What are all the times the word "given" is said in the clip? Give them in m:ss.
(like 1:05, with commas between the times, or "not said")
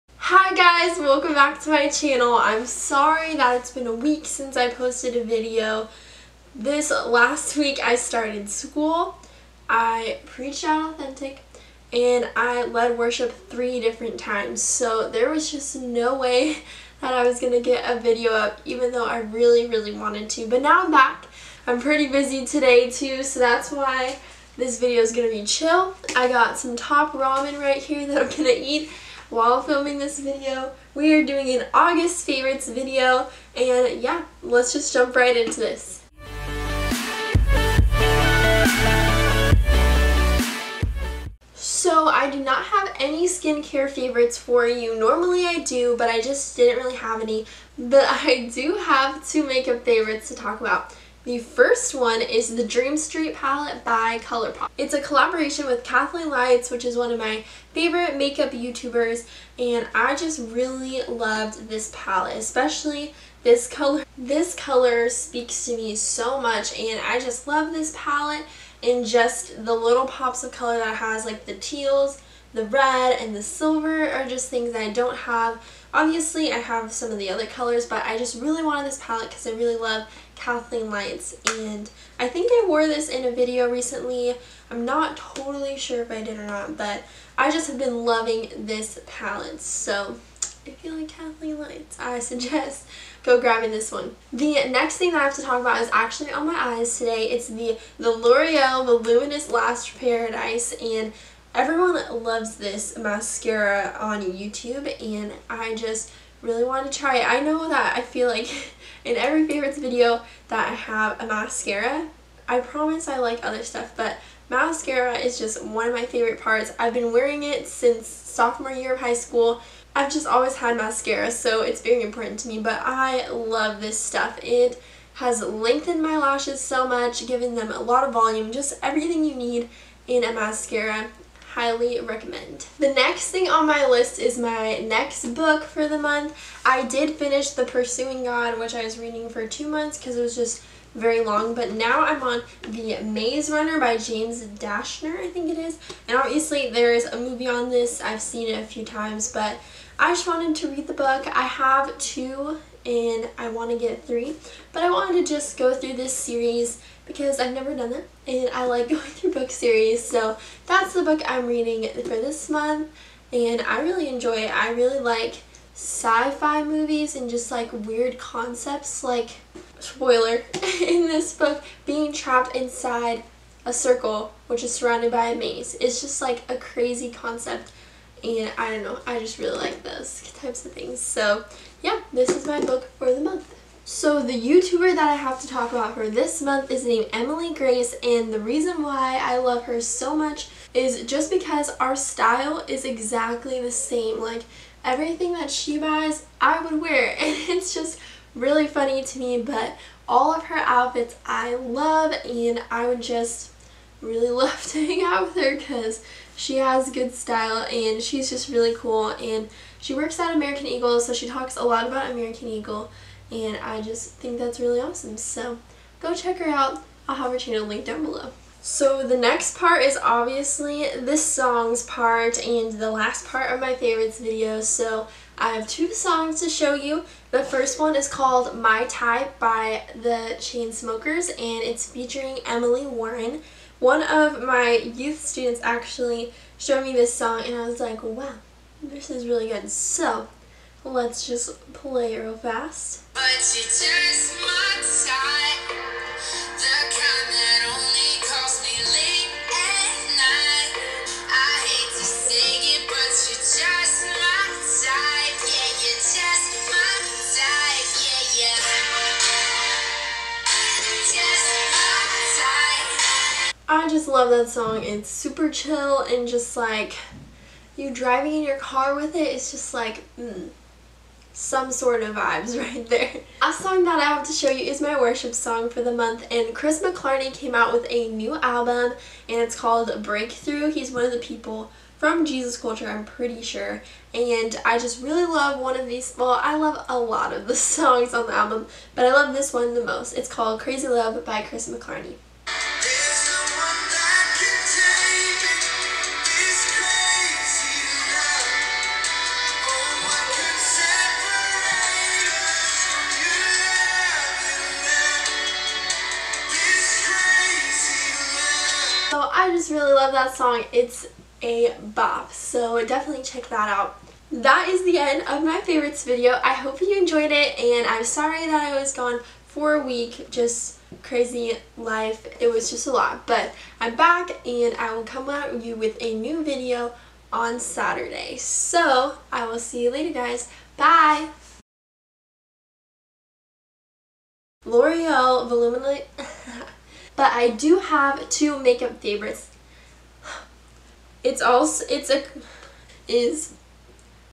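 2:07.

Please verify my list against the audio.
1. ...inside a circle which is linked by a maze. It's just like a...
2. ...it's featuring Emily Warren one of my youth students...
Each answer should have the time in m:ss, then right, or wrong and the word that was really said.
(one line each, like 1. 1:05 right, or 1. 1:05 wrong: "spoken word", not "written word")
1. 2:52 wrong: "surrounded", not "linked"
2. 3:51 right.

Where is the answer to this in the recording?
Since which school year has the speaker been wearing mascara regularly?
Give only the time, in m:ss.
1:58.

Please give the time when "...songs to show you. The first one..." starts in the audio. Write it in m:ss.
3:45.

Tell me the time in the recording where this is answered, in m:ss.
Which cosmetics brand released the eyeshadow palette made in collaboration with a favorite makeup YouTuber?
0:54.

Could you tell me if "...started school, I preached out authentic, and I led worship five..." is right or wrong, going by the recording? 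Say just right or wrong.
wrong.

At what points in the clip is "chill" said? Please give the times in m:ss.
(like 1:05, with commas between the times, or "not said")
0:25, 4:25.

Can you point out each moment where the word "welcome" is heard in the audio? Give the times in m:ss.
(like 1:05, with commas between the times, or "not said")
0:00.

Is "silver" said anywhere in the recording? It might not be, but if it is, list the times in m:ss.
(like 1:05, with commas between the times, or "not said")
1:13.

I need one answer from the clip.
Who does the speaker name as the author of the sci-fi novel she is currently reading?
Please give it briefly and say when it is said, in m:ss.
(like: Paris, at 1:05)
James Dashner, at 2:23.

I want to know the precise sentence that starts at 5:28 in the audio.
So, I will see you later, guys.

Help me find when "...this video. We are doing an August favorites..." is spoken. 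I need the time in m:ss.
0:29.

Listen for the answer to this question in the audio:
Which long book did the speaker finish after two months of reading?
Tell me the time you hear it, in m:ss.
2:17.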